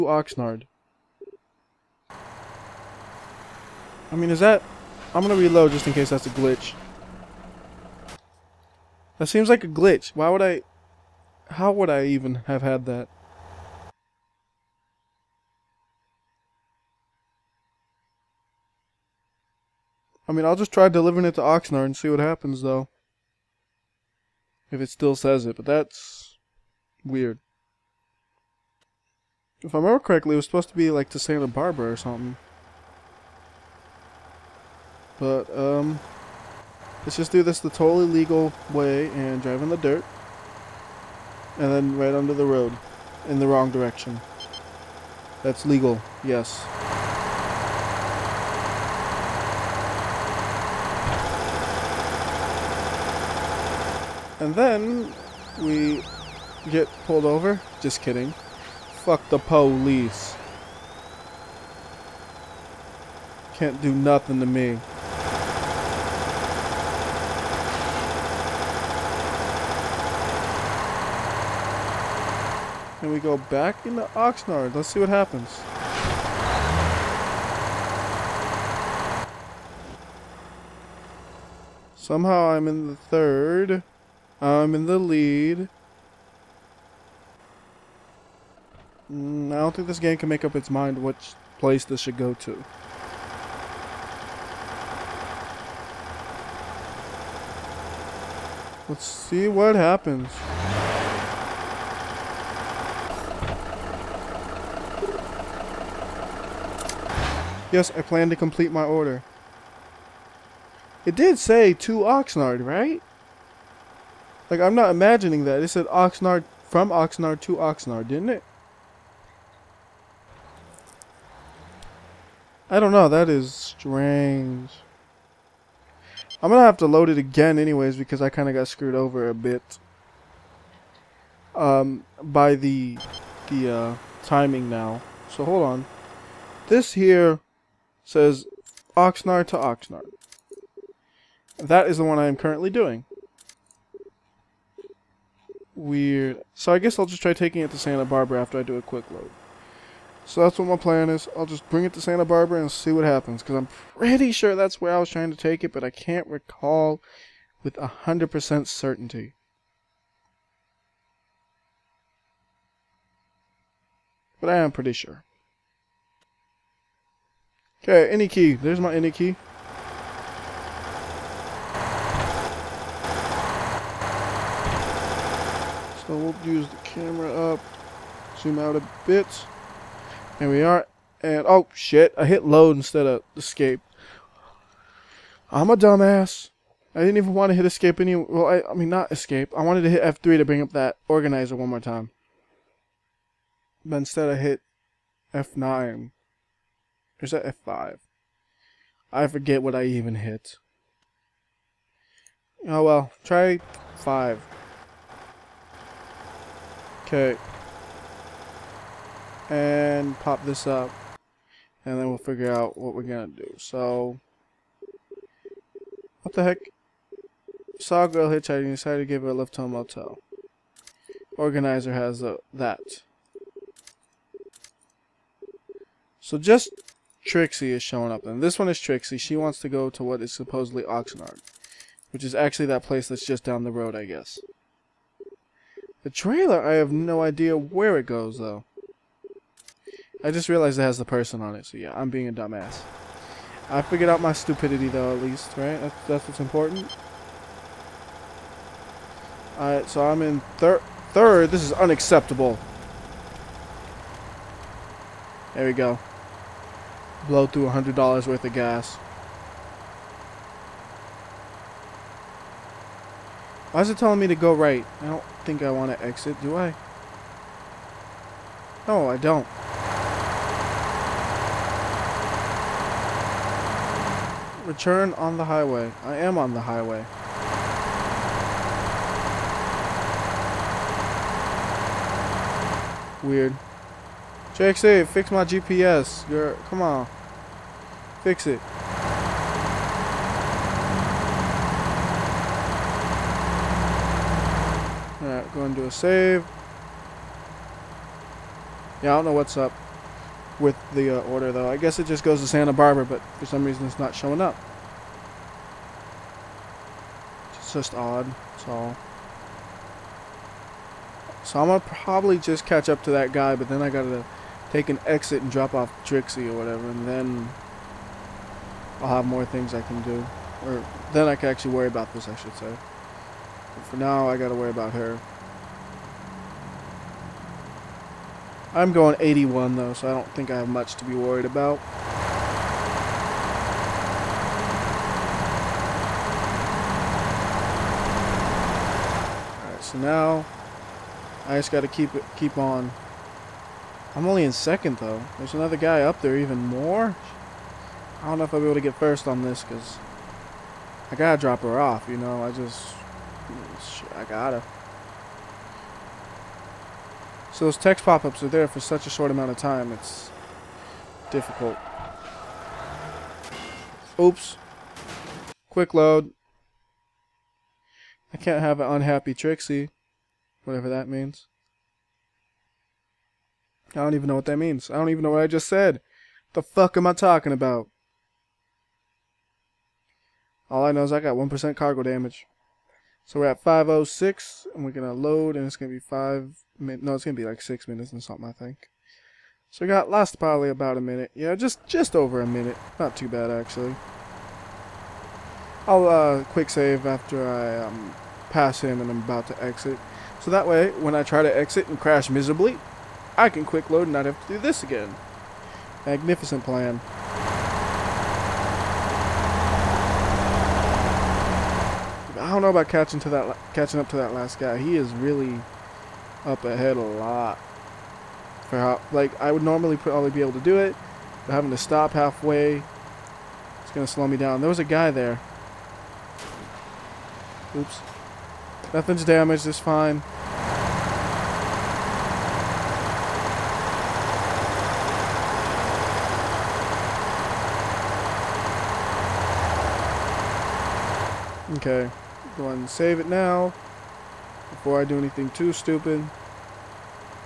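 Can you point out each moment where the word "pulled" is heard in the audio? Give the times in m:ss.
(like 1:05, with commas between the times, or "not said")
0:57.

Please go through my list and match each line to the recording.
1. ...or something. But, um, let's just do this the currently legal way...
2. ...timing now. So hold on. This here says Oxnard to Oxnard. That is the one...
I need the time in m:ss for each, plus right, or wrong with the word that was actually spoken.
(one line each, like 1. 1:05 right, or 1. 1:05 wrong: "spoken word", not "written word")
1. 0:31 wrong: "totally", not "currently"
2. 2:14 right.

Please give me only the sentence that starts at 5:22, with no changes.
But for now, I gotta worry about her.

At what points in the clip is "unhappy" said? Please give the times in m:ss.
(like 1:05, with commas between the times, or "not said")
6:08.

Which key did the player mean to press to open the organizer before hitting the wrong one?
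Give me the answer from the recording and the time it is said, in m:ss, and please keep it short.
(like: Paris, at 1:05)
F3, at 3:10.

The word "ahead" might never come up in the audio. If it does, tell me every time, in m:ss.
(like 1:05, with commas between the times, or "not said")
6:56, 7:22.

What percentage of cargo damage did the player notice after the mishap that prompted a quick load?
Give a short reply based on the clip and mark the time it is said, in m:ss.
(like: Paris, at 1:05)
1%, at 6:21.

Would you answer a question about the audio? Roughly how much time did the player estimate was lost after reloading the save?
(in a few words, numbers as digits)
about a minute.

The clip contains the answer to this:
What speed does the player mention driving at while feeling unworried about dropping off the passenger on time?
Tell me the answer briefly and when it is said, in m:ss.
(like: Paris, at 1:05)
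81, at 5:29.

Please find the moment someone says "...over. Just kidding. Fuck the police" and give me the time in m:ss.
0:57.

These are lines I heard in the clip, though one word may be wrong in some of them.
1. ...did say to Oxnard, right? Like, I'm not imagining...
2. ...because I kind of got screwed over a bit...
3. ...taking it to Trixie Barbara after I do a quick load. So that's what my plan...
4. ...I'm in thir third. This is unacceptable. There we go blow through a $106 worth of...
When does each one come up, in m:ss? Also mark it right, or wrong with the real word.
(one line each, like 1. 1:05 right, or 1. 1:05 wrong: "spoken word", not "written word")
1. 1:51 right
2. 2:07 right
3. 2:27 wrong: "Santa", not "Trixie"
4. 4:10 wrong: "100", not "106".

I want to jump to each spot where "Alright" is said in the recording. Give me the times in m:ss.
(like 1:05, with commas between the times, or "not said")
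4:09, 4:55, 5:39.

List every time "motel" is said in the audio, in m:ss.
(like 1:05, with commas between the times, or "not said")
3:39.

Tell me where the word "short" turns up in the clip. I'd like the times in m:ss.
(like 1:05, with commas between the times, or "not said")
5:59.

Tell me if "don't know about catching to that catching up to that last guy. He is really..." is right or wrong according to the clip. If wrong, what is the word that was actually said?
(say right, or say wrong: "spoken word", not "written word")
right.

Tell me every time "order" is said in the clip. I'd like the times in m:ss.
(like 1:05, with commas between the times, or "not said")
1:48, 5:01.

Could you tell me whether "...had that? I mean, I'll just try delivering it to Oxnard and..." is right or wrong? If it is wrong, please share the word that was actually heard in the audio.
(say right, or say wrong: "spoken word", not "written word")
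right.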